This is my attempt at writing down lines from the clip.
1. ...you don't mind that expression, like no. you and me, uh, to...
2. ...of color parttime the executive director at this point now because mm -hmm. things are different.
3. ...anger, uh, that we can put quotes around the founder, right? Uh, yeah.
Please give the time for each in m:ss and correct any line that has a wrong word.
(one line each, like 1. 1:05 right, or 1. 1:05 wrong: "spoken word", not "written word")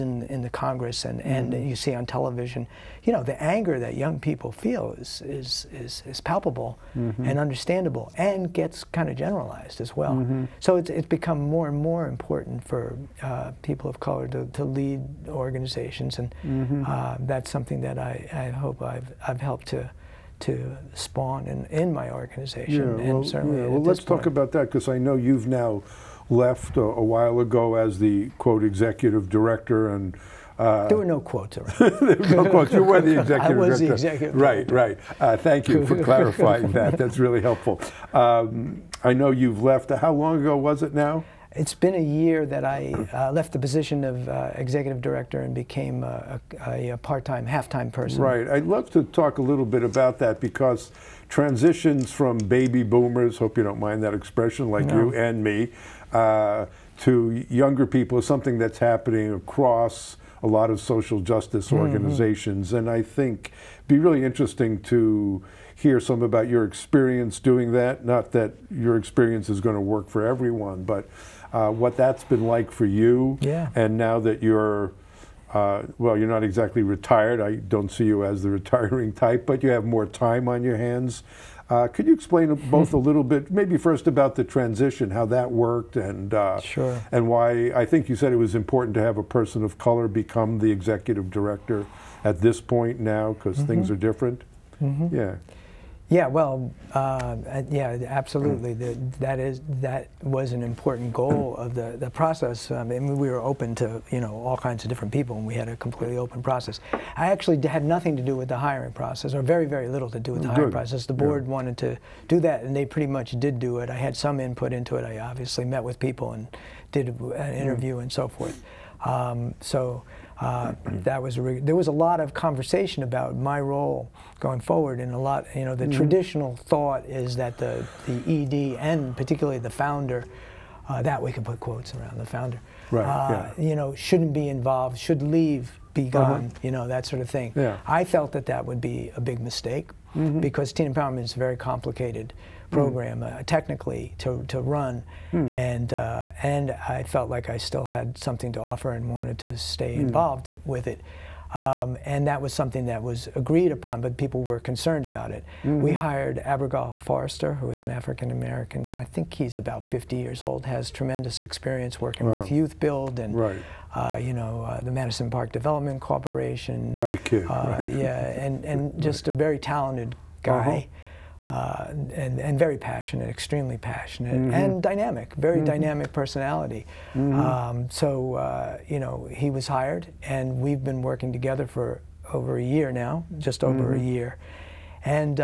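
1. 0:53 right
2. 1:29 wrong: "become", not "parttime"
3. 2:09 wrong: "founder", not "anger".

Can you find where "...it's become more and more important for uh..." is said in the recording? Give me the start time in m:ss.
0:10.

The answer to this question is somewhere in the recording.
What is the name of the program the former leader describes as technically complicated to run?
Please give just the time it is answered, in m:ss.
2:20.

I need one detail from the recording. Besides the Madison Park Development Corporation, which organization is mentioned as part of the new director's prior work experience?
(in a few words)
Youth Build.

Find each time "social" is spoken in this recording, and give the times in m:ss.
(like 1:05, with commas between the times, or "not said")
1:00.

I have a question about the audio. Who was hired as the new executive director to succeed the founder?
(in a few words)
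Abrigal Forrester.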